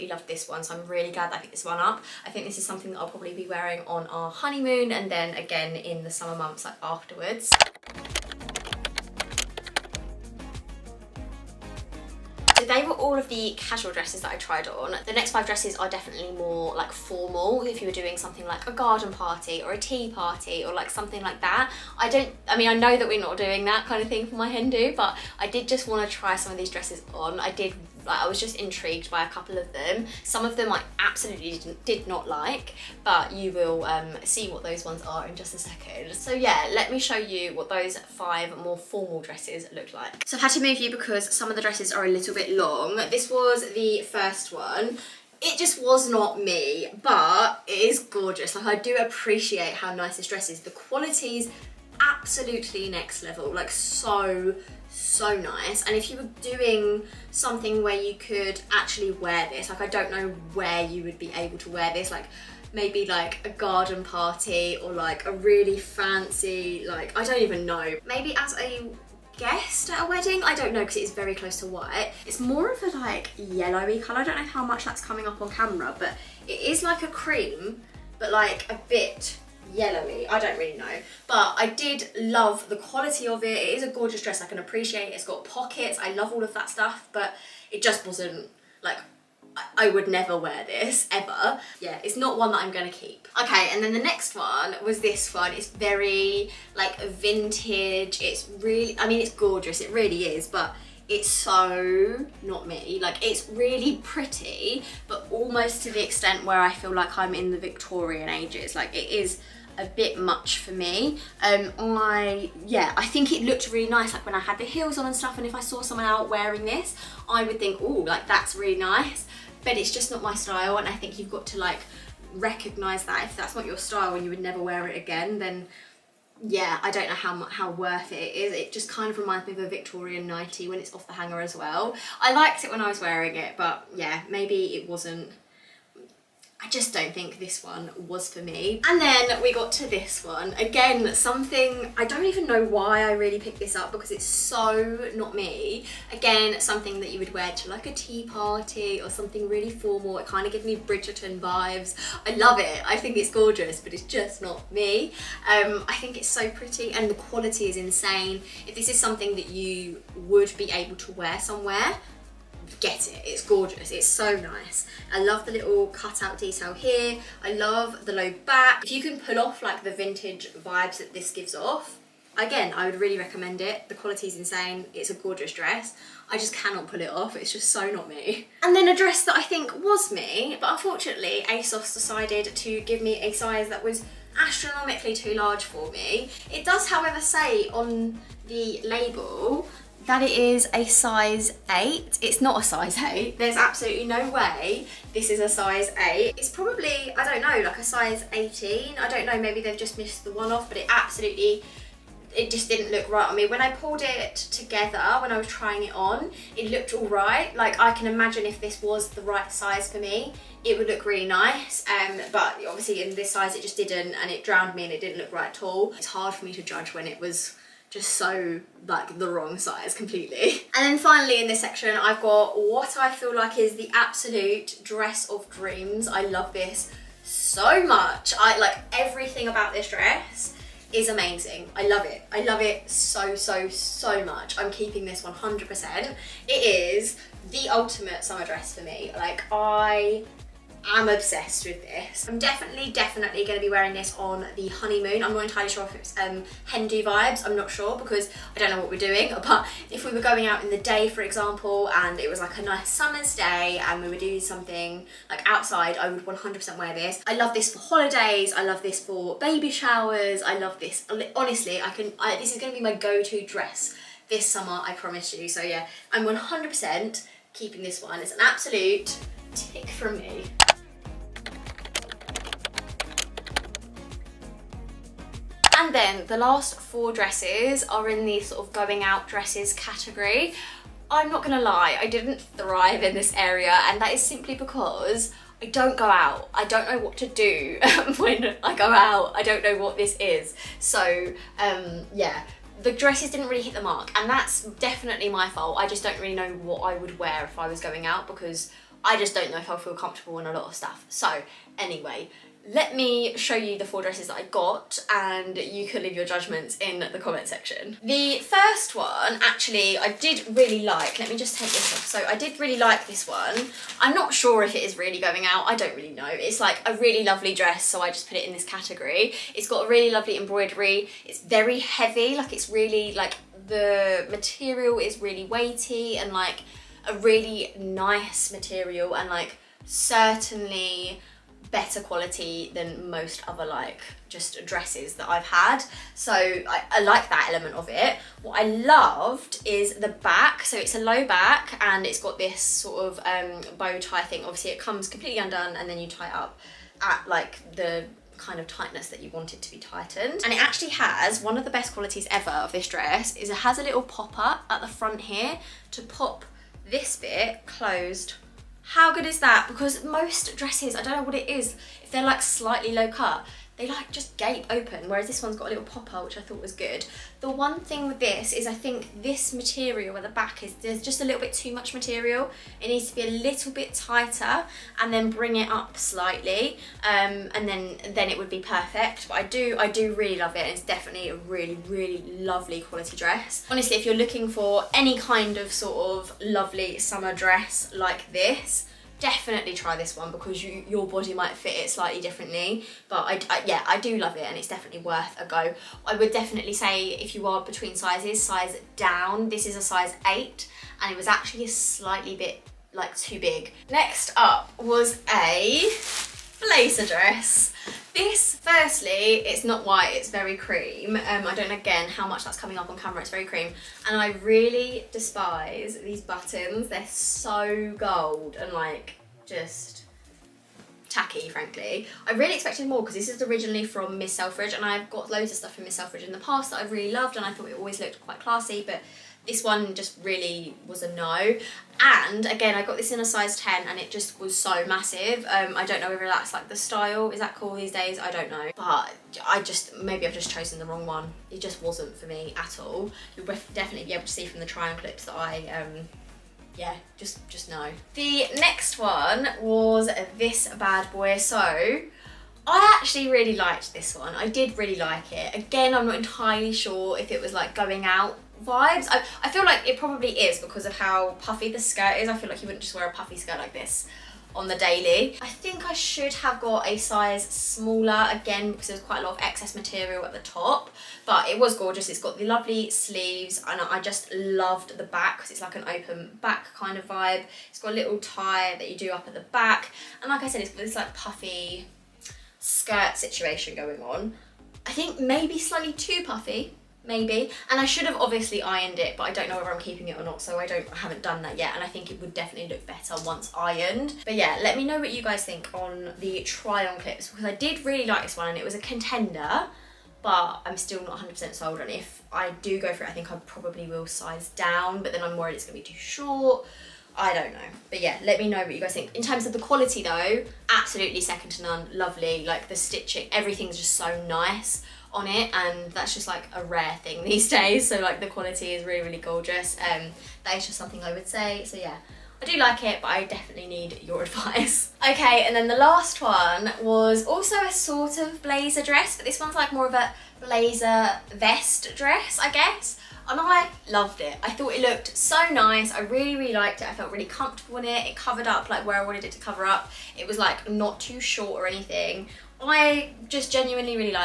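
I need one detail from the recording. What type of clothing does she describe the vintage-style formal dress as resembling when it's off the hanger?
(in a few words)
Victorian nightie.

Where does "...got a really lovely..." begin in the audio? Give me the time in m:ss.
5:19.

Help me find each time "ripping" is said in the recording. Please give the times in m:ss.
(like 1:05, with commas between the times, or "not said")
not said.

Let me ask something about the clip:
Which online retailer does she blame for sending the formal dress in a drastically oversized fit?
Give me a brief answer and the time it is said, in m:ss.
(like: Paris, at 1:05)
ASOS, at 3:01.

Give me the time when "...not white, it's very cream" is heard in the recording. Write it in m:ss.
6:49.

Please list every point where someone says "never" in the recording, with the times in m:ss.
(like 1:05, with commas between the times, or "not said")
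1:30, 2:04.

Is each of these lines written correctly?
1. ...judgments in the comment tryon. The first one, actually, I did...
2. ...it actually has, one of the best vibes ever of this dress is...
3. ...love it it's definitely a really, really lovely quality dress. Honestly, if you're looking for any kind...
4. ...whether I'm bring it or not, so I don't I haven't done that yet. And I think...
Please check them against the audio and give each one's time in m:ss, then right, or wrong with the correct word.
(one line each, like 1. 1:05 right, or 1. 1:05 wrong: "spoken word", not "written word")
1. 5:06 wrong: "section", not "tryon"
2. 5:50 wrong: "qualities", not "vibes"
3. 6:20 right
4. 8:09 wrong: "keeping", not "bring".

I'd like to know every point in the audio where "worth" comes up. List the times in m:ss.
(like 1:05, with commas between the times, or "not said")
2:07, 6:35.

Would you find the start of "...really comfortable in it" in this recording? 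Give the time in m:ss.
8:57.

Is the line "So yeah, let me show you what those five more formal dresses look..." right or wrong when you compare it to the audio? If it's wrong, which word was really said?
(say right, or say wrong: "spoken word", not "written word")
right.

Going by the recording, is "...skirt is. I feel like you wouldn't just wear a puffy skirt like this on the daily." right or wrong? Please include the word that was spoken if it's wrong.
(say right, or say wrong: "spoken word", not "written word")
right.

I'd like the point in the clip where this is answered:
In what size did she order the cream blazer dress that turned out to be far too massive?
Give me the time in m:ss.
7:13.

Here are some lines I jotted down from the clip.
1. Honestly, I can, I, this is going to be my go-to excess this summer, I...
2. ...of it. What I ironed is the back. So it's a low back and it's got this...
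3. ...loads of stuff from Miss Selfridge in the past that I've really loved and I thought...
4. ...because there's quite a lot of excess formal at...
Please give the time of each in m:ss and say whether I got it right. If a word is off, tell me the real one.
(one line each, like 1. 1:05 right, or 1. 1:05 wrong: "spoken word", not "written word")
1. 4:21 wrong: "dress", not "excess"
2. 5:37 wrong: "loved", not "ironed"
3. 7:05 right
4. 7:48 wrong: "material", not "formal".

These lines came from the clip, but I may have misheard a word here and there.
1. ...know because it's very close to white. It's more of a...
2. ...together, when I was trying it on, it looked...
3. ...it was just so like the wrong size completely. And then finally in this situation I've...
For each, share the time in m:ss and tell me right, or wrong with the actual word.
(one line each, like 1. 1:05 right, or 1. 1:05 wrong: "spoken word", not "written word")
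1. 1:10 right
2. 3:24 right
3. 3:37 wrong: "section", not "situation".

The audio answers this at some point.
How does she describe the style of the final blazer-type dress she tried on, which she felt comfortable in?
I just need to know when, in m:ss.
8:50.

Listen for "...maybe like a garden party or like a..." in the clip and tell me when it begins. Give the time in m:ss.
1:02.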